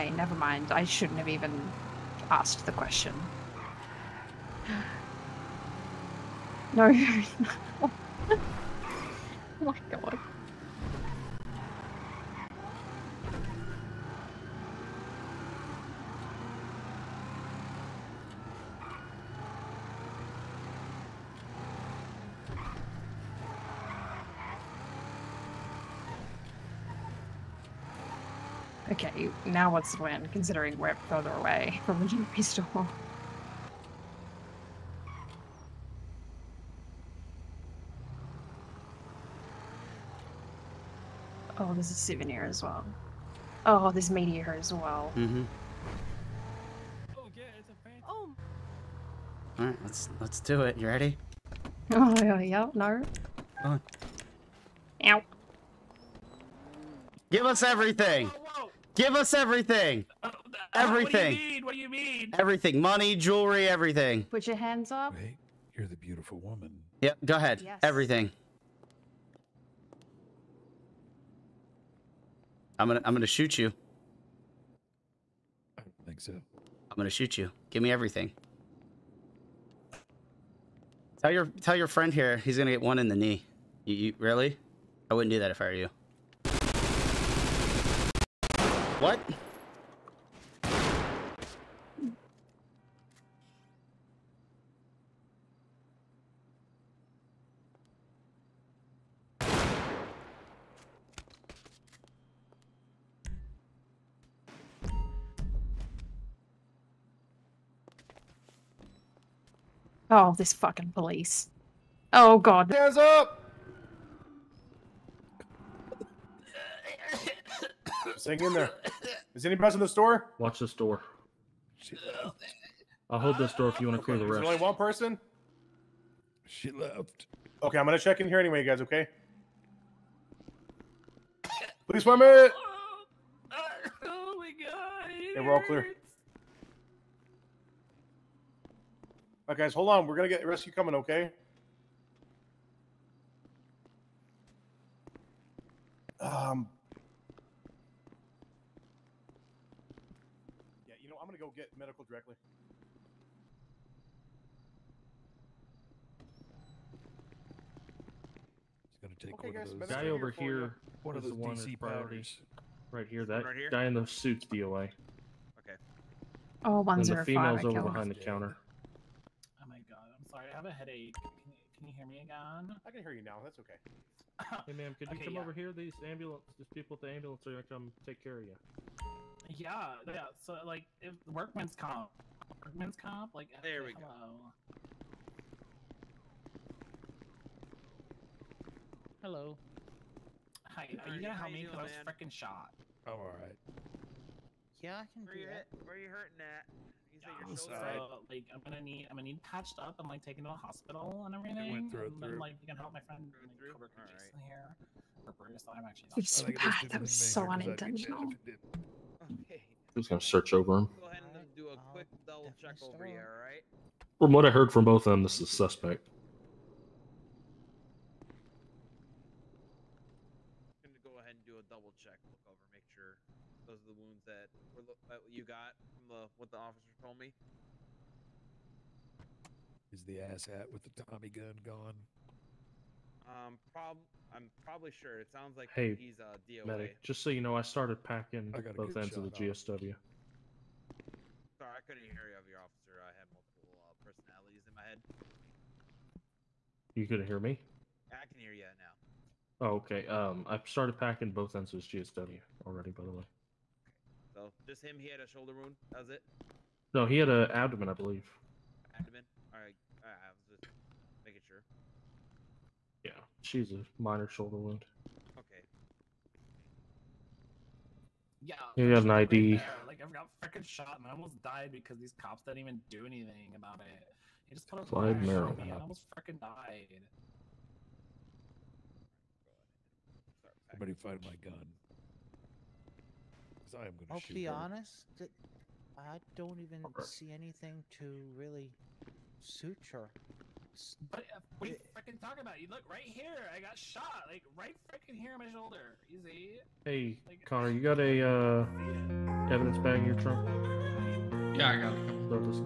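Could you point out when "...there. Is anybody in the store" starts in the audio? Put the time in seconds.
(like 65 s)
118 s.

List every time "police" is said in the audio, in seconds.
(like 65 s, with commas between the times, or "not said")
110 s, 131 s.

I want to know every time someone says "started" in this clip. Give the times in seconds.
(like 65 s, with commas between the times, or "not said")
237 s, 250 s.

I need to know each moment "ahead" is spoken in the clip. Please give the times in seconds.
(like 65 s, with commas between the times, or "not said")
67 s, 211 s, 221 s.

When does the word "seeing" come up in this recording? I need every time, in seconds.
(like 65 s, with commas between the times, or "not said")
not said.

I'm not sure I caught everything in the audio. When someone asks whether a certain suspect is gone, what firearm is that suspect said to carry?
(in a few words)
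Tommy gun.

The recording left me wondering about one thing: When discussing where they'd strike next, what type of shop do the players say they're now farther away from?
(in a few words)
jewelry store.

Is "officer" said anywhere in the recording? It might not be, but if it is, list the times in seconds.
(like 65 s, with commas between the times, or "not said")
226 s, 242 s.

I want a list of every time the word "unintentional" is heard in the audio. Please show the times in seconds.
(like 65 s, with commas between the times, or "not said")
207 s.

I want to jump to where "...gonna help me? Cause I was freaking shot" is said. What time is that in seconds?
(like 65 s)
191 s.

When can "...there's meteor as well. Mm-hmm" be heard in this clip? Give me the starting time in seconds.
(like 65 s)
43 s.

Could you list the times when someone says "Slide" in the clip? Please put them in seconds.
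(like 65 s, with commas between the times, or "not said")
274 s.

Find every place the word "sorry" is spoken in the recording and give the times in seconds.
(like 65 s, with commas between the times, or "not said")
170 s, 241 s.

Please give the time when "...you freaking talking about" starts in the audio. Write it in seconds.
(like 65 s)
291 s.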